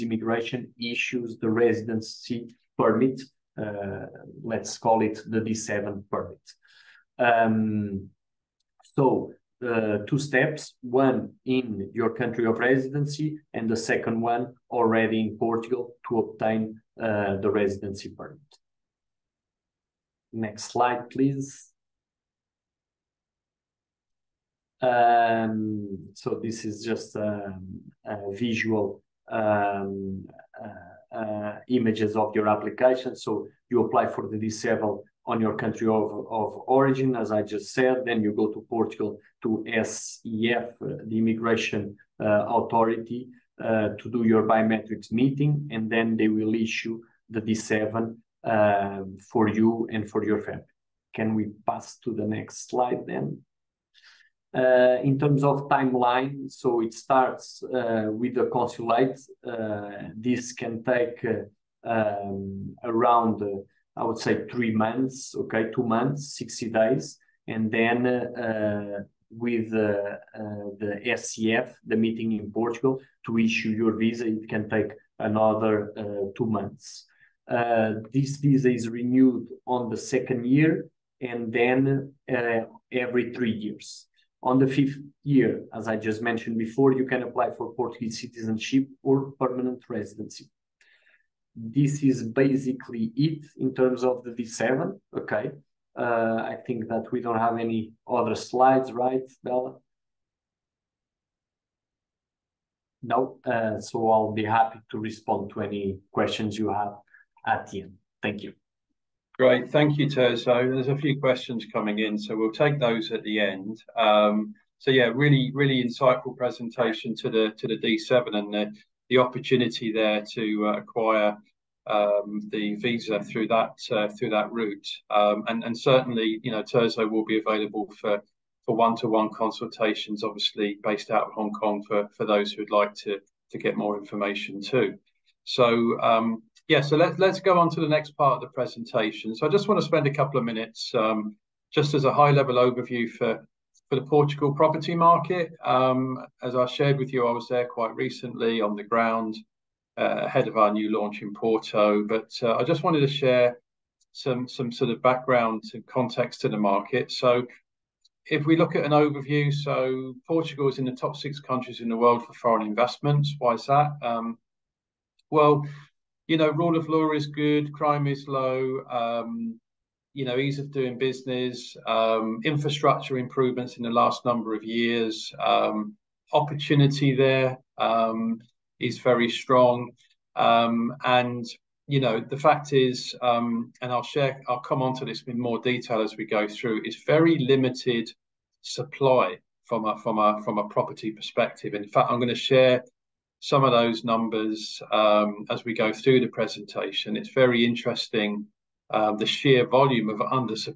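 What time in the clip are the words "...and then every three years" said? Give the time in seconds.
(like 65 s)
81 s.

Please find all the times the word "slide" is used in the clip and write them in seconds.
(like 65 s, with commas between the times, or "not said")
20 s, 52 s, 98 s.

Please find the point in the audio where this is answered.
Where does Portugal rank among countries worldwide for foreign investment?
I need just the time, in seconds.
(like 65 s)
160 s.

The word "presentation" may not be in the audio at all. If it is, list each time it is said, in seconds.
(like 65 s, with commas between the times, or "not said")
116 s, 138 s, 196 s.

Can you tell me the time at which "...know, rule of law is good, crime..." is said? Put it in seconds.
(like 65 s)
166 s.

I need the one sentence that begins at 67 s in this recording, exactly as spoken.
And then uh, with the SEF, the meeting in Portugal, to issue your visa, it can take another two months.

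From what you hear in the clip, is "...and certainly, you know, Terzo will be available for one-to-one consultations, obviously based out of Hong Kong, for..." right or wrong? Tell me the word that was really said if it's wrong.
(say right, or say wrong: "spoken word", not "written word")
right.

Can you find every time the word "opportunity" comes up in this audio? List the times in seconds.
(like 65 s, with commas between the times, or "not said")
119 s, 176 s.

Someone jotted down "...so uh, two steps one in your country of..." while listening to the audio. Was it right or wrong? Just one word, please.
right.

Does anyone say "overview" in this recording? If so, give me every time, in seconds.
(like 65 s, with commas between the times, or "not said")
142 s, 158 s.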